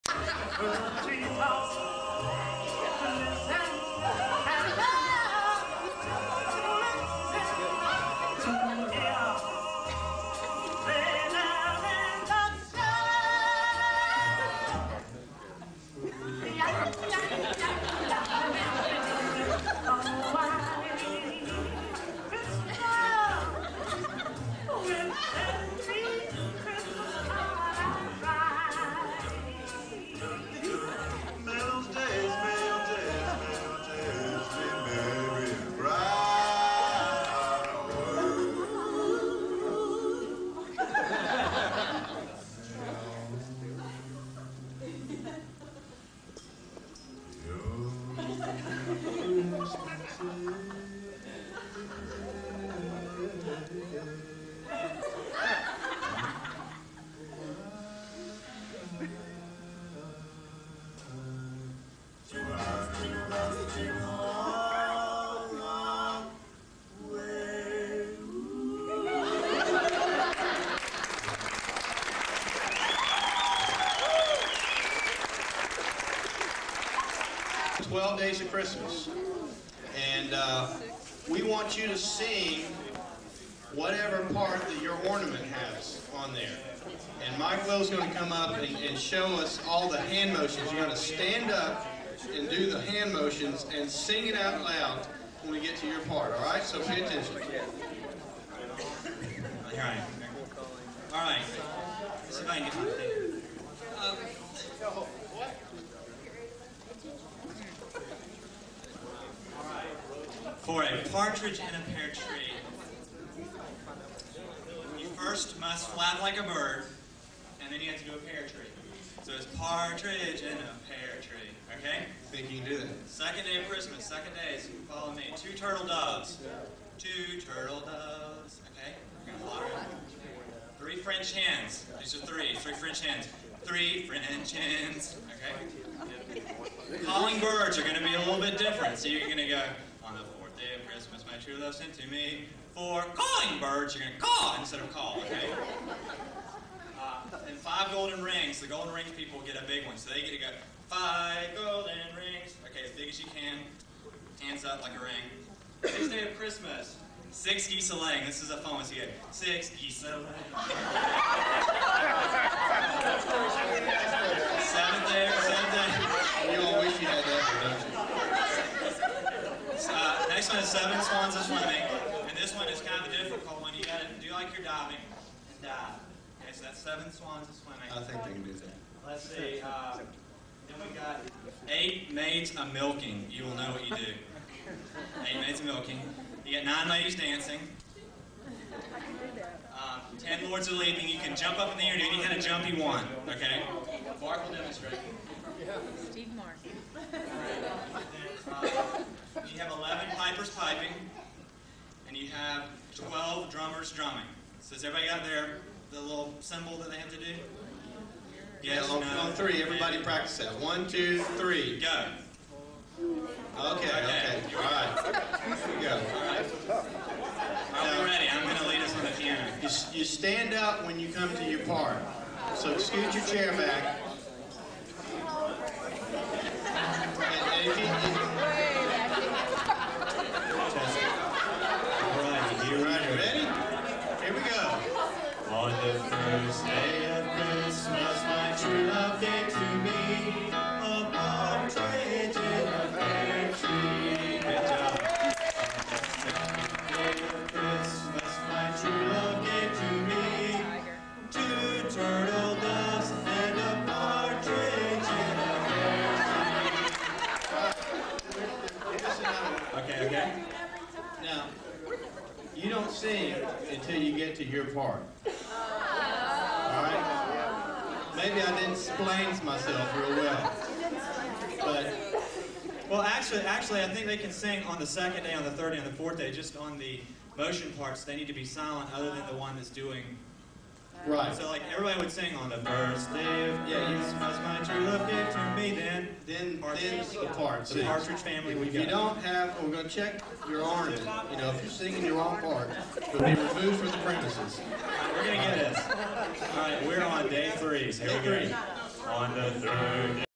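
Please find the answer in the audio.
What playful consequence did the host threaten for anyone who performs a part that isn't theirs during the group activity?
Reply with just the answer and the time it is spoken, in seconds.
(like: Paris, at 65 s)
Removed from the premises, at 293 s.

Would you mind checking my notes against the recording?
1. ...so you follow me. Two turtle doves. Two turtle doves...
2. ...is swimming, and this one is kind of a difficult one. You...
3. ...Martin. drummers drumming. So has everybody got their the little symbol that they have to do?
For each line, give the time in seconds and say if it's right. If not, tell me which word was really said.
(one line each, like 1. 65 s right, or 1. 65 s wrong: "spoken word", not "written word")
1. 124 s right
2. 171 s right
3. 196 s right.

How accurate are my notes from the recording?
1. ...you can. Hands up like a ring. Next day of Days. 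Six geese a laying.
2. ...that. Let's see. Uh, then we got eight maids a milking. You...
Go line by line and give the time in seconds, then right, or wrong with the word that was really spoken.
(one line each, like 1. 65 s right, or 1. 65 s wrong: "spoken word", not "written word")
1. 153 s wrong: "Christmas", not "Days"
2. 178 s right.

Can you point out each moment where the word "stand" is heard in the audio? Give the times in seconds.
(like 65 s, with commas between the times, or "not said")
91 s, 220 s.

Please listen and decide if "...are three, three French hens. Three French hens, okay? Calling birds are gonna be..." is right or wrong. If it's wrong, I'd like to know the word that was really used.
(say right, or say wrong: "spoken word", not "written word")
right.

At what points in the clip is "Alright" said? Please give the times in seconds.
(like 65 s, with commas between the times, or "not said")
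266 s.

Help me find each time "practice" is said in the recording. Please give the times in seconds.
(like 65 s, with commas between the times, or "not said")
210 s.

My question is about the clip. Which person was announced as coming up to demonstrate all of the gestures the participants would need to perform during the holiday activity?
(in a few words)
Mike Will.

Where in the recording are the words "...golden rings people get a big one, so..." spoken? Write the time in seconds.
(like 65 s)
148 s.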